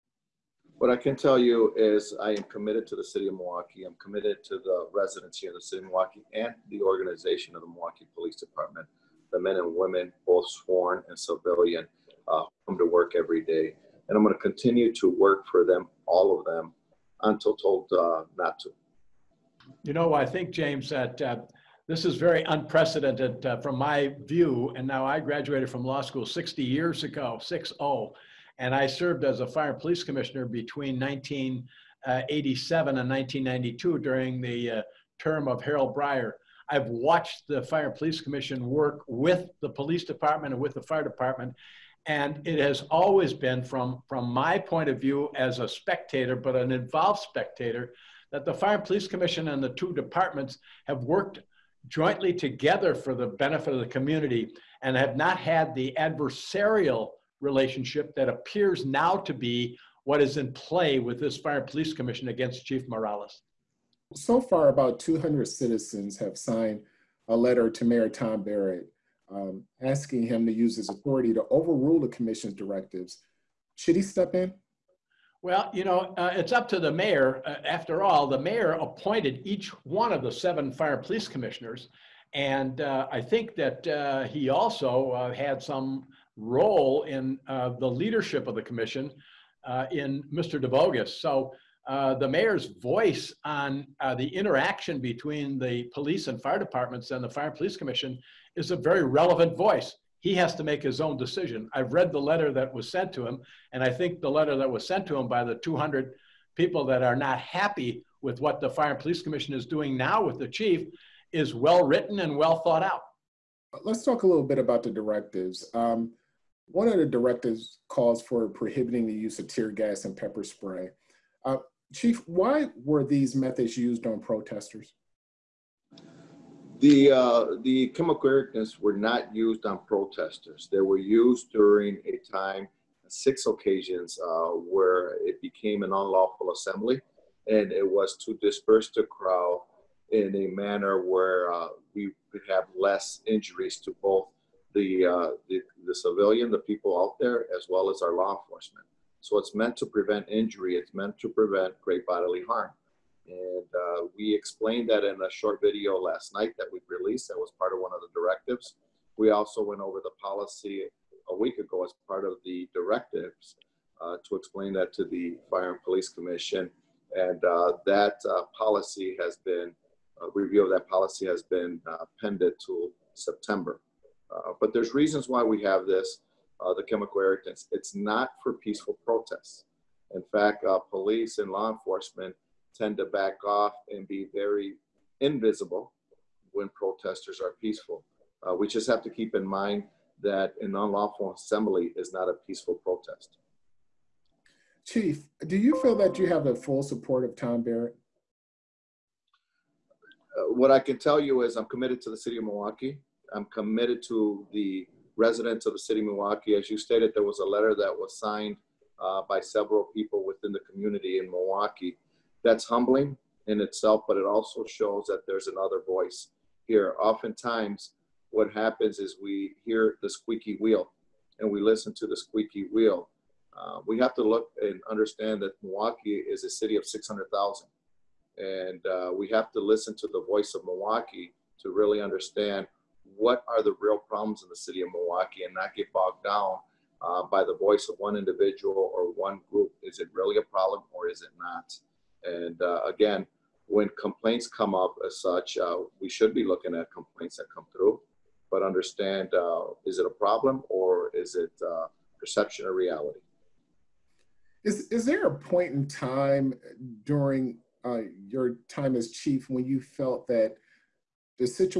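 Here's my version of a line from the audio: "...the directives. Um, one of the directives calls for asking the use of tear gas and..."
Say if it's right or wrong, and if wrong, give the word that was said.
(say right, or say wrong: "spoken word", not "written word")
wrong: "prohibiting", not "asking".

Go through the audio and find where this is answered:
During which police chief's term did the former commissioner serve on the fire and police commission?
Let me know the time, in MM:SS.
00:35.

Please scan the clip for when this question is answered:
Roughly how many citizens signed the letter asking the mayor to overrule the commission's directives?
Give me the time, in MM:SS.
01:04.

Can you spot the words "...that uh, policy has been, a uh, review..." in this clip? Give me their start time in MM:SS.
02:47.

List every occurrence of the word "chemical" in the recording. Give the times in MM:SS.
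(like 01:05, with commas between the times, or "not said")
02:07, 02:56.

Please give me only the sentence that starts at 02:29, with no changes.
So it's meant to prevent injury.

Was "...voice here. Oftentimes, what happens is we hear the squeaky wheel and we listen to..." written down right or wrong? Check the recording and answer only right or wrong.
right.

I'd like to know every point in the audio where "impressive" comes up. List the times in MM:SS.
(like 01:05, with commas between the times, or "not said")
not said.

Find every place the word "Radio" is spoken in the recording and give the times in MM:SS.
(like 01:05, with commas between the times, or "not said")
not said.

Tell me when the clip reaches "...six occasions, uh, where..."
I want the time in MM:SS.
02:13.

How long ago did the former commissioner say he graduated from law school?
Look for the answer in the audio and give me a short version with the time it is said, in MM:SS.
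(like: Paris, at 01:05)
60 years, at 00:26.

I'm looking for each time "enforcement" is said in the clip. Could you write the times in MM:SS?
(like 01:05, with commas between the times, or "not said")
02:28, 03:01.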